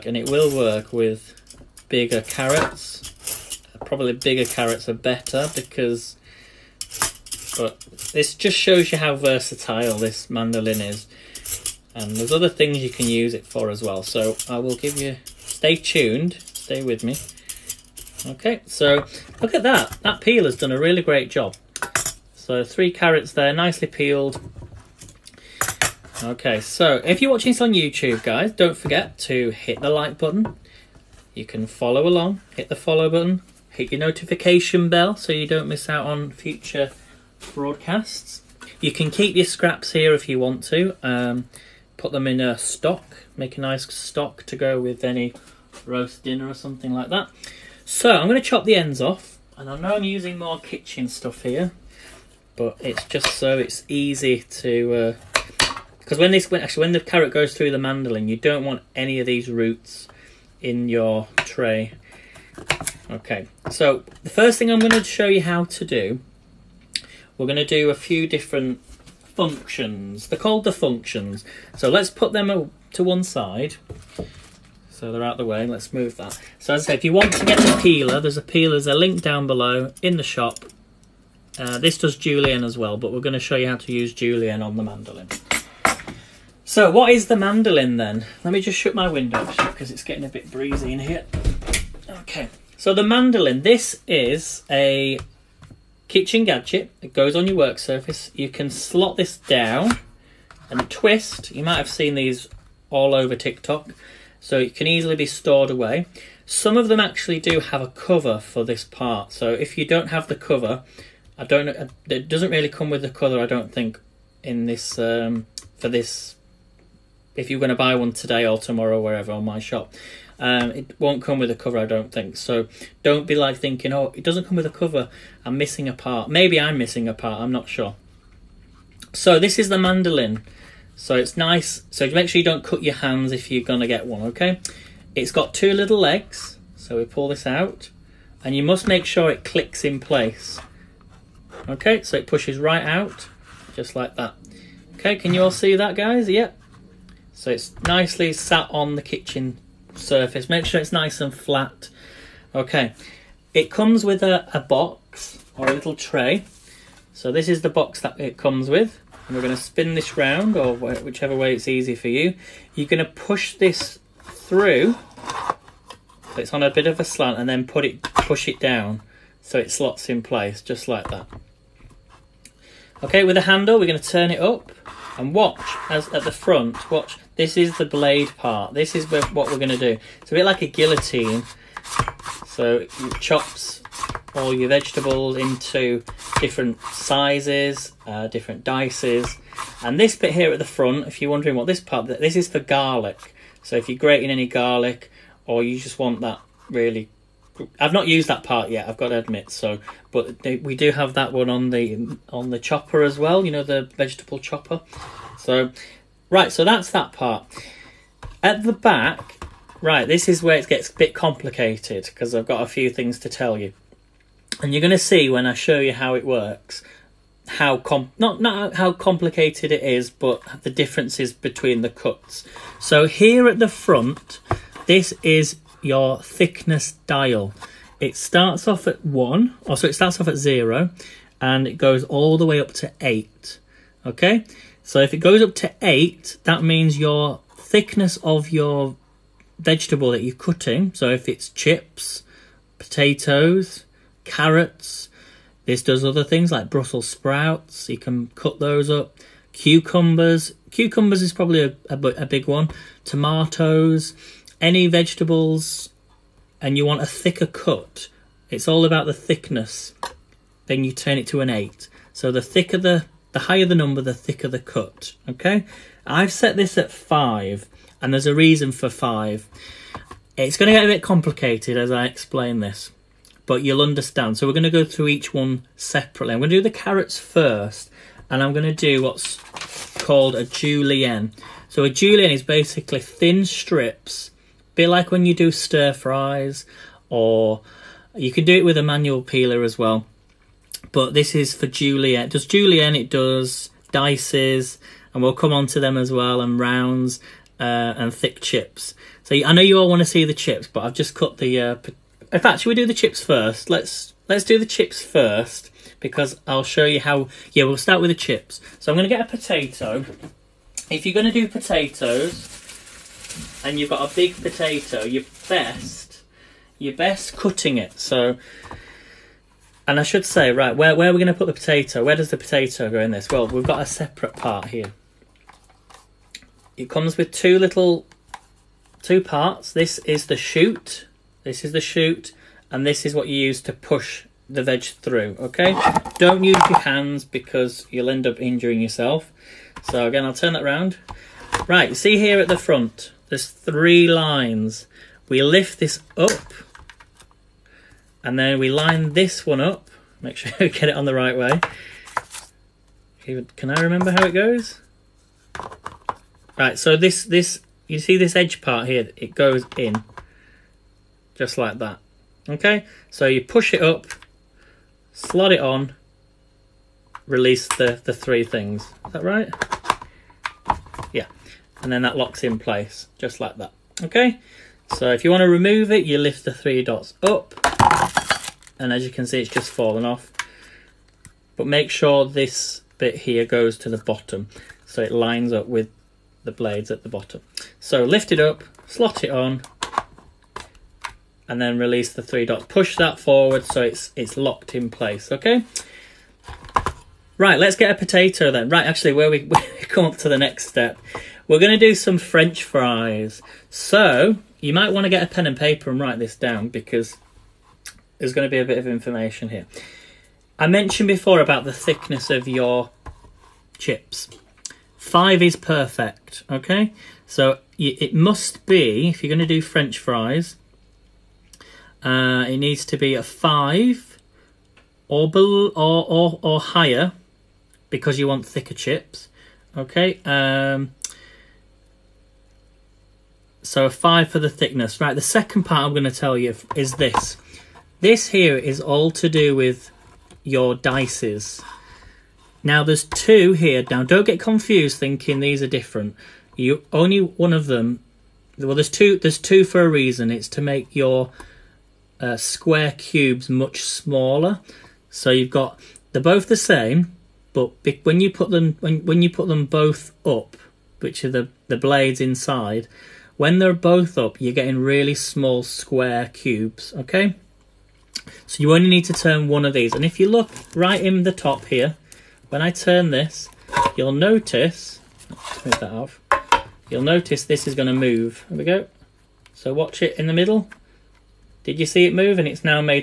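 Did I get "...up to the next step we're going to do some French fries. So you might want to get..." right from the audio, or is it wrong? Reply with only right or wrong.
right.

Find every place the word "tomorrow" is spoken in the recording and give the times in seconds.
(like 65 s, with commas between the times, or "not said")
118 s.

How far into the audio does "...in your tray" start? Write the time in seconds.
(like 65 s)
60 s.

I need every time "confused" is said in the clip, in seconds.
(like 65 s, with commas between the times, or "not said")
444 s.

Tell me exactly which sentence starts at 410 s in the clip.
I mentioned before about the thickness of your chips.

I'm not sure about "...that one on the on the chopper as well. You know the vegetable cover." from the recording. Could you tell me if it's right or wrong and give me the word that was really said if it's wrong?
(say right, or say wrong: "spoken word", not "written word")
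wrong: "chopper", not "cover".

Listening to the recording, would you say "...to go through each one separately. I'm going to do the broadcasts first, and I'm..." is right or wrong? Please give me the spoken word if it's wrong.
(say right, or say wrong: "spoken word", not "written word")
wrong: "carrots", not "broadcasts".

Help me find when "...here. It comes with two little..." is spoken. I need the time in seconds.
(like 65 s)
324 s.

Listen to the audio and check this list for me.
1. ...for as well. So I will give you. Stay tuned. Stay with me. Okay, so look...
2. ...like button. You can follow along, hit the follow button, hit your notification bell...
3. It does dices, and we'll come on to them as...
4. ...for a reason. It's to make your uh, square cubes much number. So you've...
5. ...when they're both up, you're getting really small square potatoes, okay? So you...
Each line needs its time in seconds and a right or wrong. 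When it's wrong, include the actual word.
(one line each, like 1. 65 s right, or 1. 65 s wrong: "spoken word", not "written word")
1. 13 s right
2. 29 s right
3. 292 s right
4. 449 s wrong: "smaller", not "number"
5. 463 s wrong: "cubes", not "potatoes".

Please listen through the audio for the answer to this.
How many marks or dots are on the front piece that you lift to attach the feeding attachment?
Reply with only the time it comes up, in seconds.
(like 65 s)
343 s.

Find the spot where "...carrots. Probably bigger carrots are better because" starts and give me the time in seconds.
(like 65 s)
2 s.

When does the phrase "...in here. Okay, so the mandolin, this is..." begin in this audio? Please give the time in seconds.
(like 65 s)
90 s.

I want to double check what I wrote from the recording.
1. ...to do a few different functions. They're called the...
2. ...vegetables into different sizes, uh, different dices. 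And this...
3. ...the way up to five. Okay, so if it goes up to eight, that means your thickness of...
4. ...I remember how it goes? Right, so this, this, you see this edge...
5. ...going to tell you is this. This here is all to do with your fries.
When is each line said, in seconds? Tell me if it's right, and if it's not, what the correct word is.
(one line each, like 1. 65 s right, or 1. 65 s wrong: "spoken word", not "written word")
1. 67 s right
2. 184 s right
3. 232 s wrong: "eight", not "five"
4. 353 s right
5. 435 s wrong: "dices", not "fries".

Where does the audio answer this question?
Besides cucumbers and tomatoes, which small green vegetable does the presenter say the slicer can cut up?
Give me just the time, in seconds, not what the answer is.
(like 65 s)
246 s.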